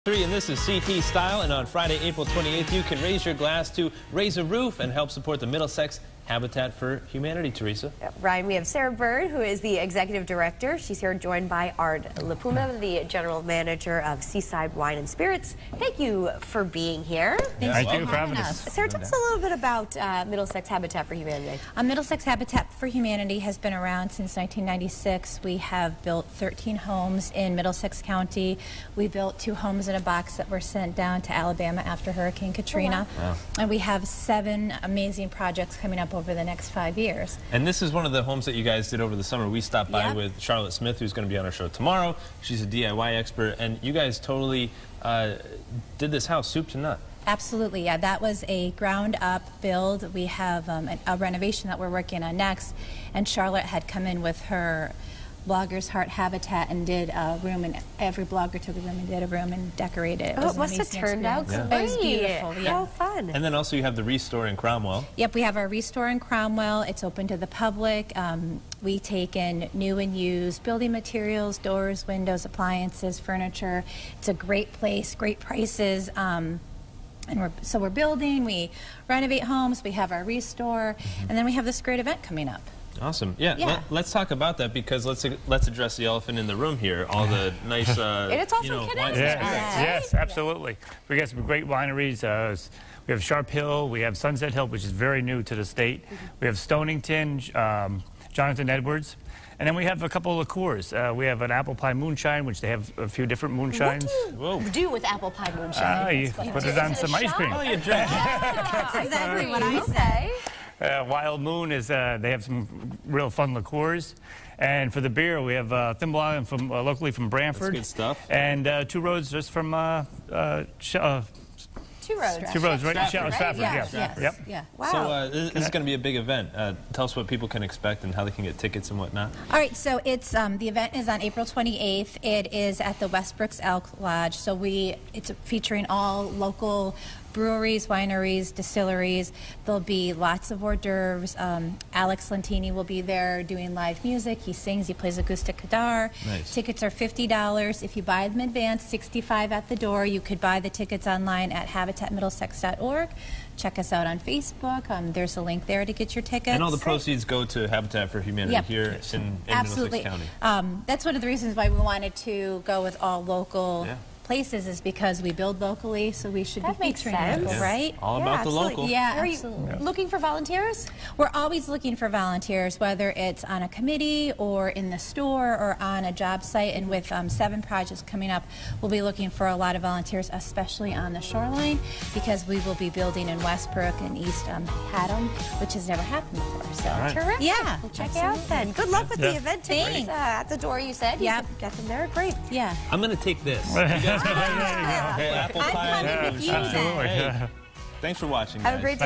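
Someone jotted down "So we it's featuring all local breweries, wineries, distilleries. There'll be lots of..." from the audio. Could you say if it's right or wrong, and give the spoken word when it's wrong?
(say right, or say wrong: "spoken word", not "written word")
right.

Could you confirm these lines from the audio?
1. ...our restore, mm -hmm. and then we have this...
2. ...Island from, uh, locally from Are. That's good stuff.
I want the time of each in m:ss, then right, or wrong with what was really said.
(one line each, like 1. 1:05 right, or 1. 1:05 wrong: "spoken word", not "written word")
1. 1:20 right
2. 1:56 wrong: "Branford", not "Are".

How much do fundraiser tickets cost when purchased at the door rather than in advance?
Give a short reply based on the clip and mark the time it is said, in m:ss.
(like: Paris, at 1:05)
$65, at 2:28.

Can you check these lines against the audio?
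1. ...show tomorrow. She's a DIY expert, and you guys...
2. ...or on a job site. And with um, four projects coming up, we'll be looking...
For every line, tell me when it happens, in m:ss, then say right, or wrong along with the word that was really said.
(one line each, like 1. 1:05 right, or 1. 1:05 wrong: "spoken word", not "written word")
1. 0:41 right
2. 2:55 wrong: "seven", not "four".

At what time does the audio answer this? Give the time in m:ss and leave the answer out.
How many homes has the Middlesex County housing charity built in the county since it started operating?
0:26.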